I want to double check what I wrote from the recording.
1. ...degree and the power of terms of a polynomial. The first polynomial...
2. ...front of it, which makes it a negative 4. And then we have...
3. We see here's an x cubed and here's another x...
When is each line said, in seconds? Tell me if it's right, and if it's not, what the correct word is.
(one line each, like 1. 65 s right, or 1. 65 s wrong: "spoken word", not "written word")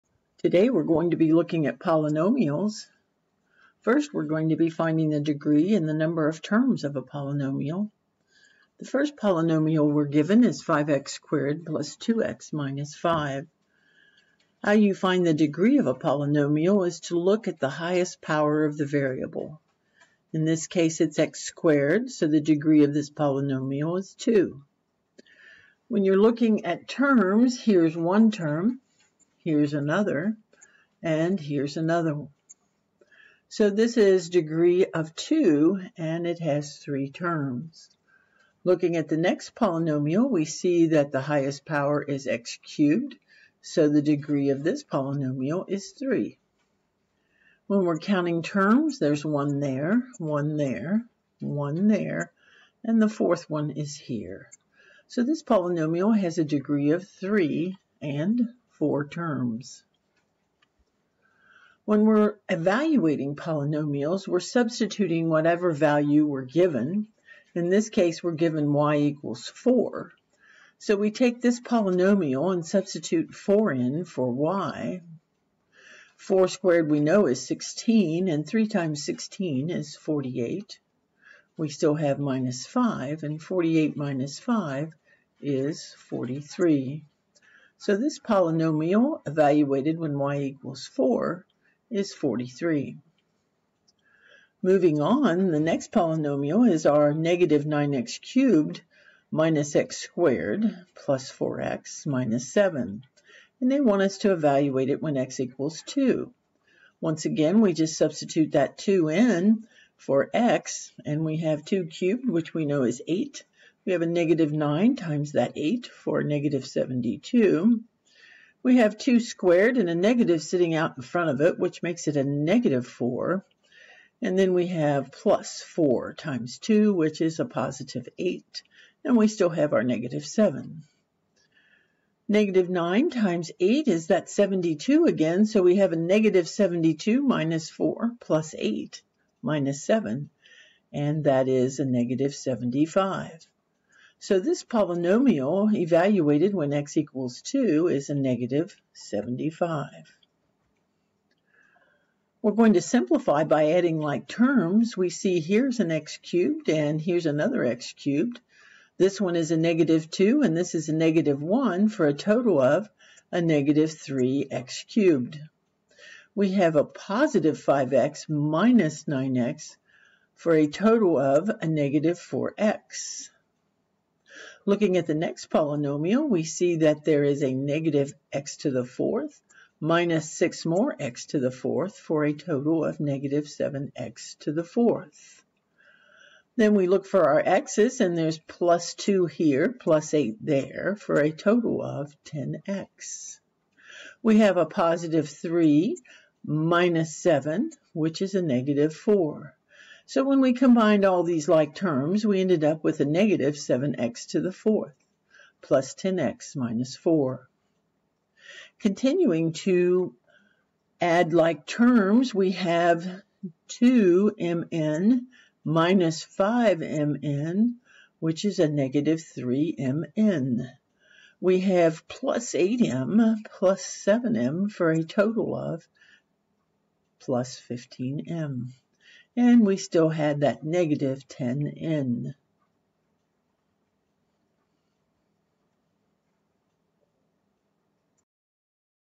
1. 5 s wrong: "number", not "power"
2. 121 s right
3. 154 s right.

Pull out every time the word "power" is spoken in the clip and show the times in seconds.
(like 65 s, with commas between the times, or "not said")
18 s, 41 s.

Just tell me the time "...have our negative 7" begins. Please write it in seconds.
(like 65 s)
129 s.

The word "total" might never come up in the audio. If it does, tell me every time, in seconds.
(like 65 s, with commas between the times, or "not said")
162 s, 170 s, 182 s, 191 s, 225 s.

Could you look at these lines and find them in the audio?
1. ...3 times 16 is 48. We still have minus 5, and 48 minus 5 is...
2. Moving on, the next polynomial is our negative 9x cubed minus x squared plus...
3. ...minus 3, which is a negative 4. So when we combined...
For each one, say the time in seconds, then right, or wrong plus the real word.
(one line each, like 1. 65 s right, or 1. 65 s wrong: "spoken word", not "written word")
1. 78 s right
2. 94 s right
3. 196 s wrong: "7", not "3".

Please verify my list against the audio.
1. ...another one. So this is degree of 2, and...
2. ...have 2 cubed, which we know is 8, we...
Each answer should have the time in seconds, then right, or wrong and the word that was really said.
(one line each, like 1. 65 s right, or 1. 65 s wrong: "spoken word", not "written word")
1. 31 s right
2. 111 s right.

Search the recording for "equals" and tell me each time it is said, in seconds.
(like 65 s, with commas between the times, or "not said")
68 s, 90 s, 105 s, 146 s.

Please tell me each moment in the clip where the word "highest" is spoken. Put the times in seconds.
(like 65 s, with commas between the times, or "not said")
17 s, 41 s.